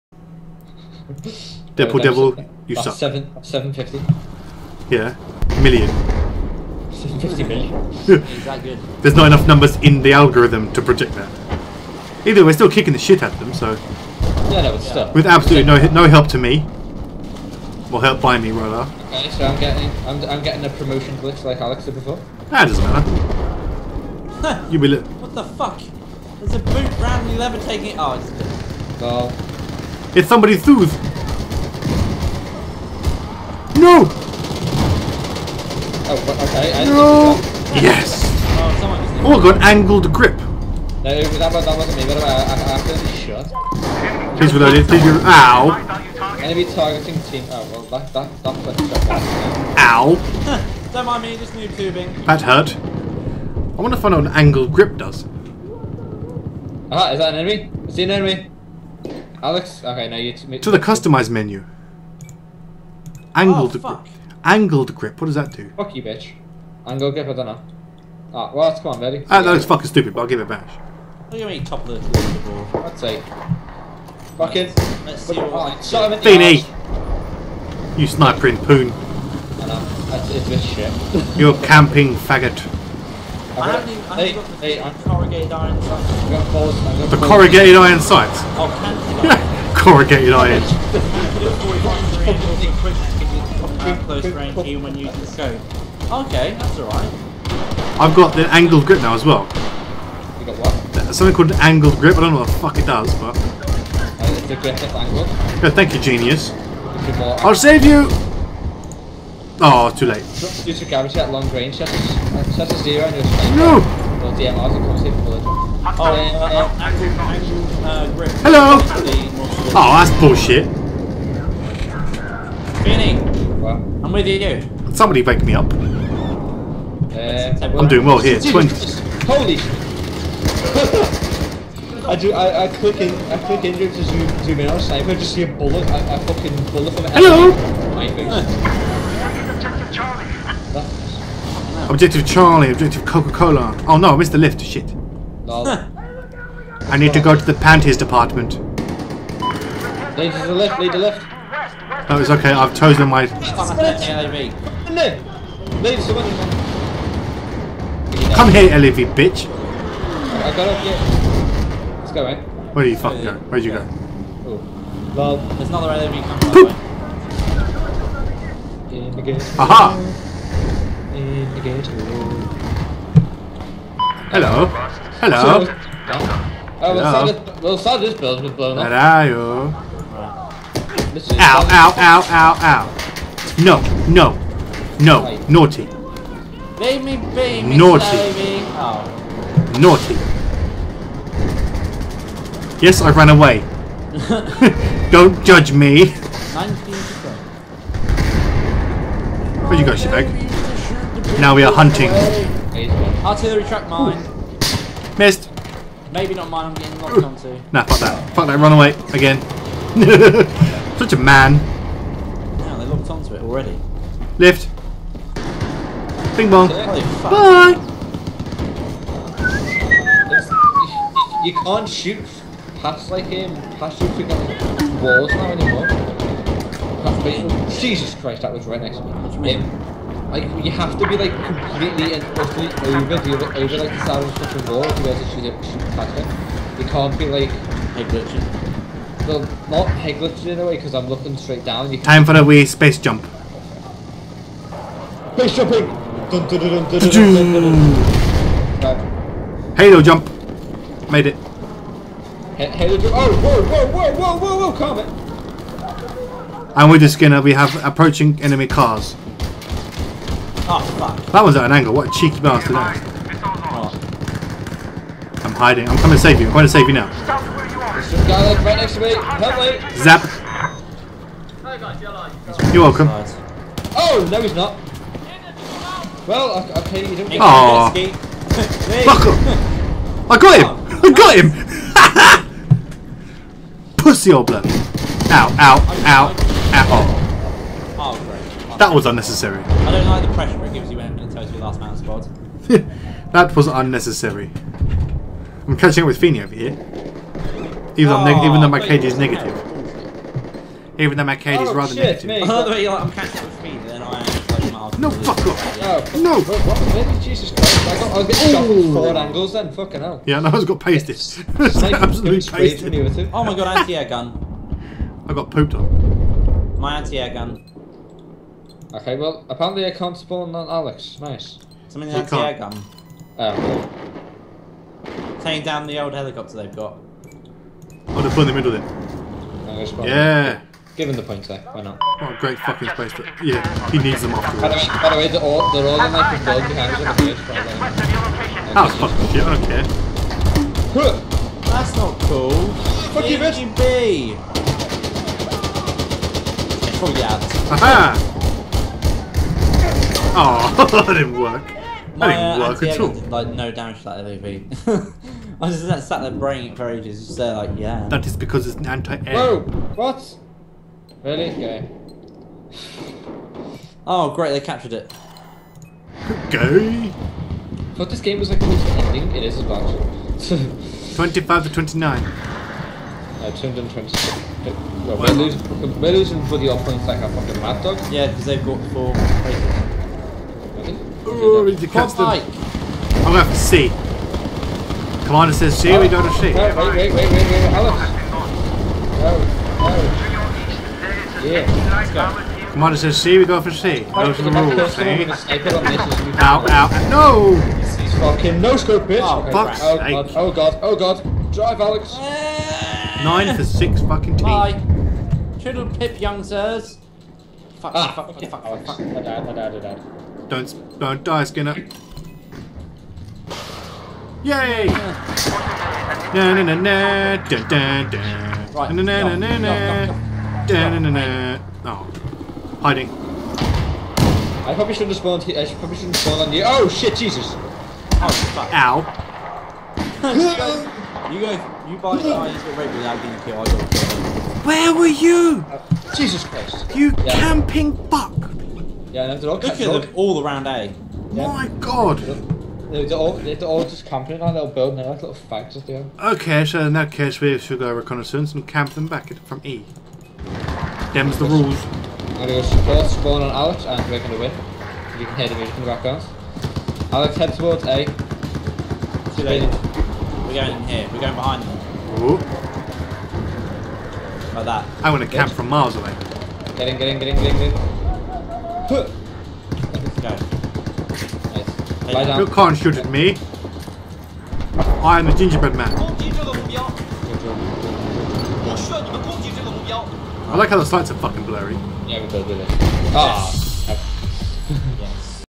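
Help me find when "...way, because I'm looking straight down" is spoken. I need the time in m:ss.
4:00.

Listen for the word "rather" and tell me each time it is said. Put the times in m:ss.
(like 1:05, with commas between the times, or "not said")
0:18, 5:01.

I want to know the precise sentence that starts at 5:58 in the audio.
That is because it's an anti-air.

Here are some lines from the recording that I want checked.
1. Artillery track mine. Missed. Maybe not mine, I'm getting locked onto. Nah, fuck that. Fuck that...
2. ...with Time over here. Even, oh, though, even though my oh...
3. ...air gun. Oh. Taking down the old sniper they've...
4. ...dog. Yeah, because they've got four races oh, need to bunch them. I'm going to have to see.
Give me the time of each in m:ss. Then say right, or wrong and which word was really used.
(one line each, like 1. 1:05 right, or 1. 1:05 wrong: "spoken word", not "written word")
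1. 3:23 right
2. 4:56 wrong: "Feeney", not "Time"
3. 5:22 wrong: "helicopter", not "sniper"
4. 6:17 wrong: "catch", not "bunch".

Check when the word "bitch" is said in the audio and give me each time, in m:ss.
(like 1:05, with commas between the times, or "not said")
1:06, 2:39, 5:43, 6:39.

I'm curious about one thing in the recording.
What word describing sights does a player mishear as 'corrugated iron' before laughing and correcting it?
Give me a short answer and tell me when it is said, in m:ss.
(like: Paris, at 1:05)
canted, at 1:28.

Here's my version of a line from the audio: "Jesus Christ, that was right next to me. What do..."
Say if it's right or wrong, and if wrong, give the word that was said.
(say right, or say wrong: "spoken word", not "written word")
right.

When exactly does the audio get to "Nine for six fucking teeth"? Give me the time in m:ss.
6:43.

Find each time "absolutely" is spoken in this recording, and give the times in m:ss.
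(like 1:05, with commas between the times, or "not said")
0:15, 5:11.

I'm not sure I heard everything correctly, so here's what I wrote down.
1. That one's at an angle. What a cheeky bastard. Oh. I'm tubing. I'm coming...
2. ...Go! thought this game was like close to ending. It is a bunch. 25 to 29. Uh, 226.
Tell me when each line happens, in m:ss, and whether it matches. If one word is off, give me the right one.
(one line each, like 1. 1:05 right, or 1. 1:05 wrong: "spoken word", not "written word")
1. 4:21 wrong: "hiding", not "tubing"
2. 6:06 right.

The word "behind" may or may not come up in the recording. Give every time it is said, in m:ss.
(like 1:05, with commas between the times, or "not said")
5:36, 7:41.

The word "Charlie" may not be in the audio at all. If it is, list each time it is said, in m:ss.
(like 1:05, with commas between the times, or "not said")
2:22.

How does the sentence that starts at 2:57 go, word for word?
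this, we'll sell this building blown up.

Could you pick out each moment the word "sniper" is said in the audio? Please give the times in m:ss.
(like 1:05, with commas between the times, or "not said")
1:18, 2:14.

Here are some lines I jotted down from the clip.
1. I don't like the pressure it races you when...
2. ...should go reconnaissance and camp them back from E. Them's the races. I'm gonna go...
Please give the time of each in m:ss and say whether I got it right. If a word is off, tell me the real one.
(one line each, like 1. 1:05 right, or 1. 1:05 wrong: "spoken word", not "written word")
1. 4:49 wrong: "gives", not "races"
2. 7:27 wrong: "rules", not "races".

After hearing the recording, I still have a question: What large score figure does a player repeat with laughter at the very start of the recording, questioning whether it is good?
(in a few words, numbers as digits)
750 million.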